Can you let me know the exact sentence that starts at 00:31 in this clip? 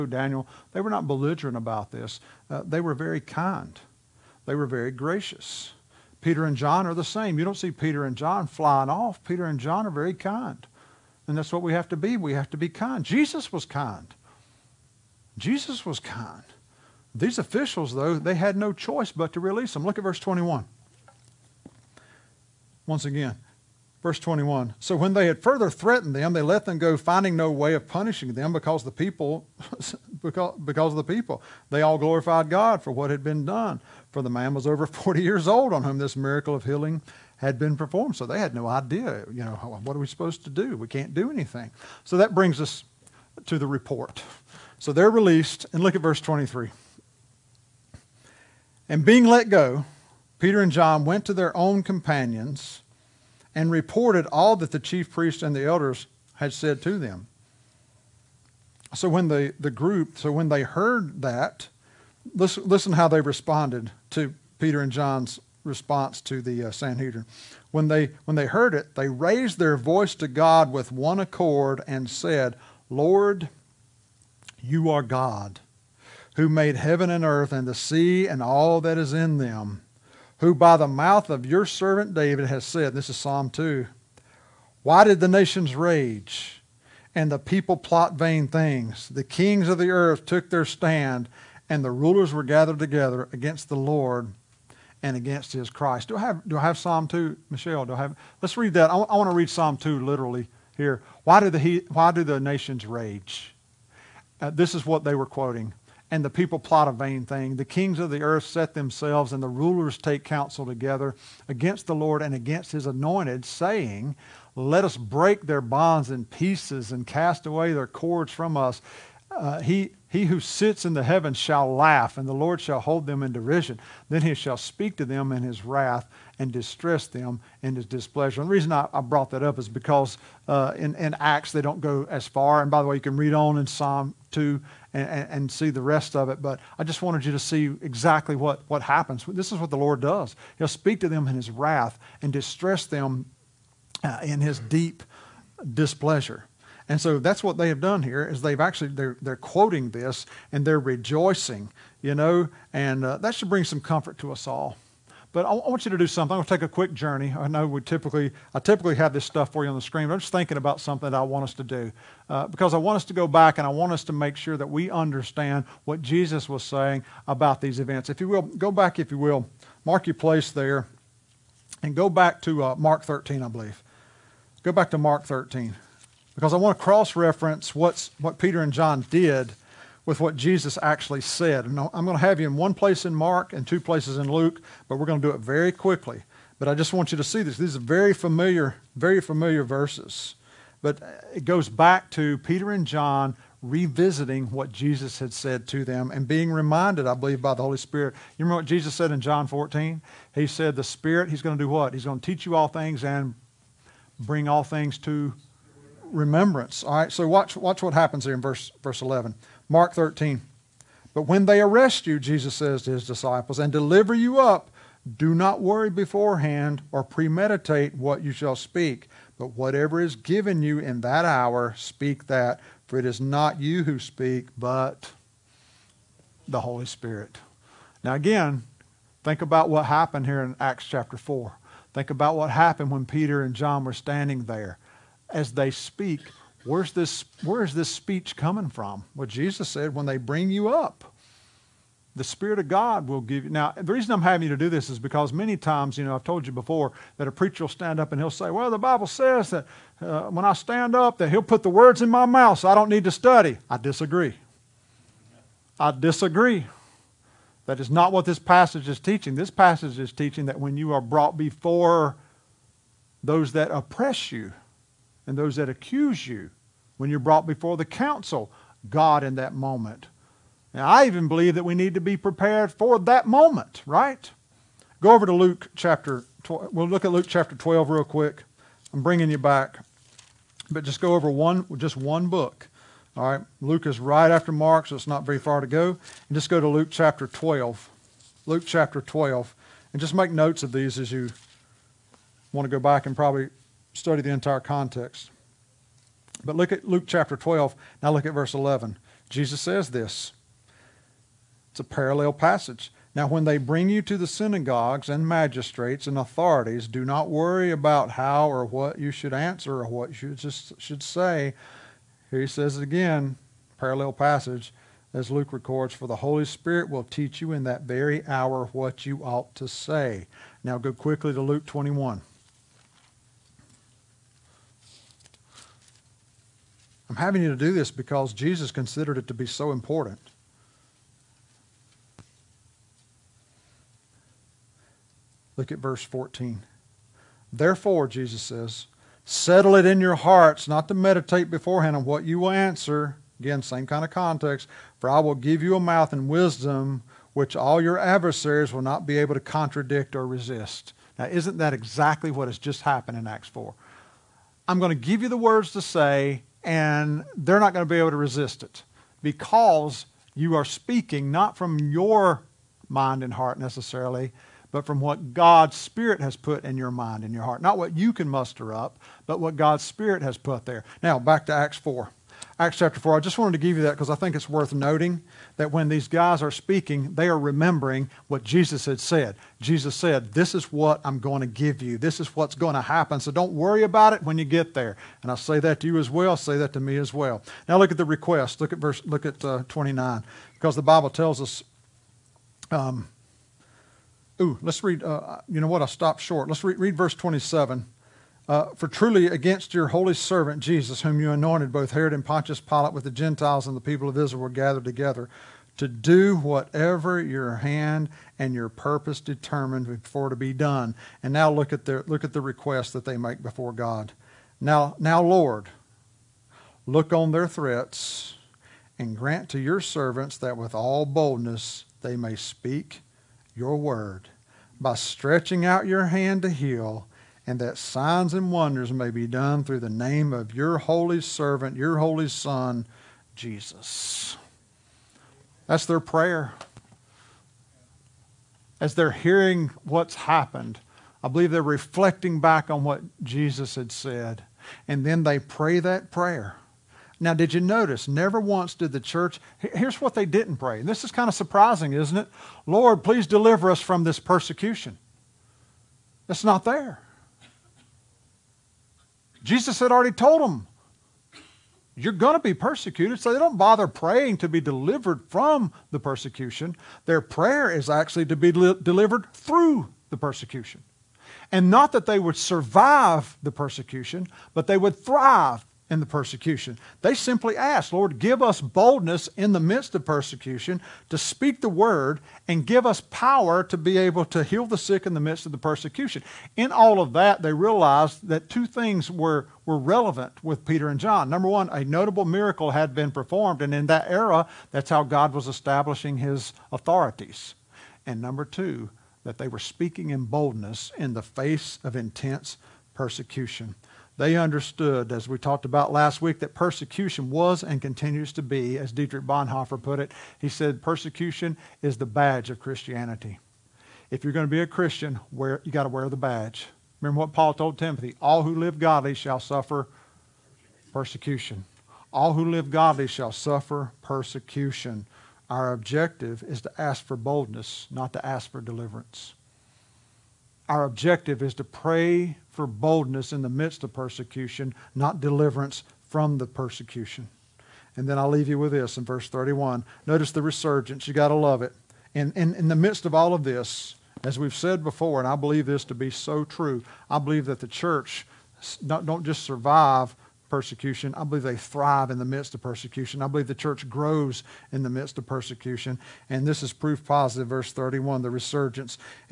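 They all glorified God for what had been done.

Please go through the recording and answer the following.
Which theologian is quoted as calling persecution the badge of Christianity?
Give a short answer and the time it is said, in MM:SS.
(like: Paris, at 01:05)
Dietrich Bonhoeffer, at 08:28.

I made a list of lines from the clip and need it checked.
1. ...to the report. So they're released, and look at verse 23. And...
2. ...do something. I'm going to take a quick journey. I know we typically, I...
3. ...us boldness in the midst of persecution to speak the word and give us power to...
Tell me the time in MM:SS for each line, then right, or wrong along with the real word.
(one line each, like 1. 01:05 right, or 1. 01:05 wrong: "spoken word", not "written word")
1. 00:43 right
2. 02:35 right
3. 07:58 right.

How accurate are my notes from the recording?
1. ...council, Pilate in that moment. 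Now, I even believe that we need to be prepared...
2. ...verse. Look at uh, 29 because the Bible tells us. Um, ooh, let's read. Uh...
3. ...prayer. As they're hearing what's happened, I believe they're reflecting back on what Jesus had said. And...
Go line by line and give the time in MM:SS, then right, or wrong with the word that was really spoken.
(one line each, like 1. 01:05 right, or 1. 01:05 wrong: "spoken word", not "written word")
1. 04:27 wrong: "God", not "Pilate"
2. 06:28 right
3. 07:16 right.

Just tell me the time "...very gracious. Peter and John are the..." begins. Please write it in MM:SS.
00:04.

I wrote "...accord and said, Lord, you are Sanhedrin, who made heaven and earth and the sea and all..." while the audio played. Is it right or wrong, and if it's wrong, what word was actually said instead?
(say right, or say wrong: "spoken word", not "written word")
wrong: "God", not "Sanhedrin".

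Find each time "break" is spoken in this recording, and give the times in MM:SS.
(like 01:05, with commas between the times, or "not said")
01:54.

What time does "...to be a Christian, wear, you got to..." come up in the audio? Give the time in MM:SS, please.
08:34.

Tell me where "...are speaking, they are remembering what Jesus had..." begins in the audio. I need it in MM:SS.
06:16.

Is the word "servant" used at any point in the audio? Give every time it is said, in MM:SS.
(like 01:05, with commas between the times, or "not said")
01:21, 06:40, 06:59, 07:11.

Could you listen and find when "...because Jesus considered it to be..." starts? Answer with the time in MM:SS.
05:27.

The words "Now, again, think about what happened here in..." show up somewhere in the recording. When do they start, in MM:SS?
03:48.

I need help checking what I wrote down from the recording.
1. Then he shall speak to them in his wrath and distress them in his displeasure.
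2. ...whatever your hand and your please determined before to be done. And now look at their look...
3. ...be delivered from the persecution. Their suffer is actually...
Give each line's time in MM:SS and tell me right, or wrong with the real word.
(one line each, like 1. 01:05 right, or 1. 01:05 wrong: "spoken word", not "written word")
1. 02:04 right
2. 06:46 wrong: "purpose", not "please"
3. 07:44 wrong: "prayer", not "suffer".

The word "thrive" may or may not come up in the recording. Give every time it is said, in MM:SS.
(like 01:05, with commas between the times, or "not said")
07:54, 09:11.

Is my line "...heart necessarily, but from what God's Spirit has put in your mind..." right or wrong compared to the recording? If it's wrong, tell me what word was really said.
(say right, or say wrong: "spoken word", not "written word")
right.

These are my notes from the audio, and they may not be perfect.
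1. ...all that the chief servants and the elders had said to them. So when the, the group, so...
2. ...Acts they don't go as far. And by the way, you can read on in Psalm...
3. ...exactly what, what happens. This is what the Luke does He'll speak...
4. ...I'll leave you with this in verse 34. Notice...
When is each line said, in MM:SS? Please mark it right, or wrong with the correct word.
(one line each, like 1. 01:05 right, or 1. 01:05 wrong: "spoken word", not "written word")
1. 00:54 wrong: "priests", not "servants"
2. 02:11 right
3. 02:17 wrong: "Lord", not "Luke"
4. 08:58 wrong: "31", not "34".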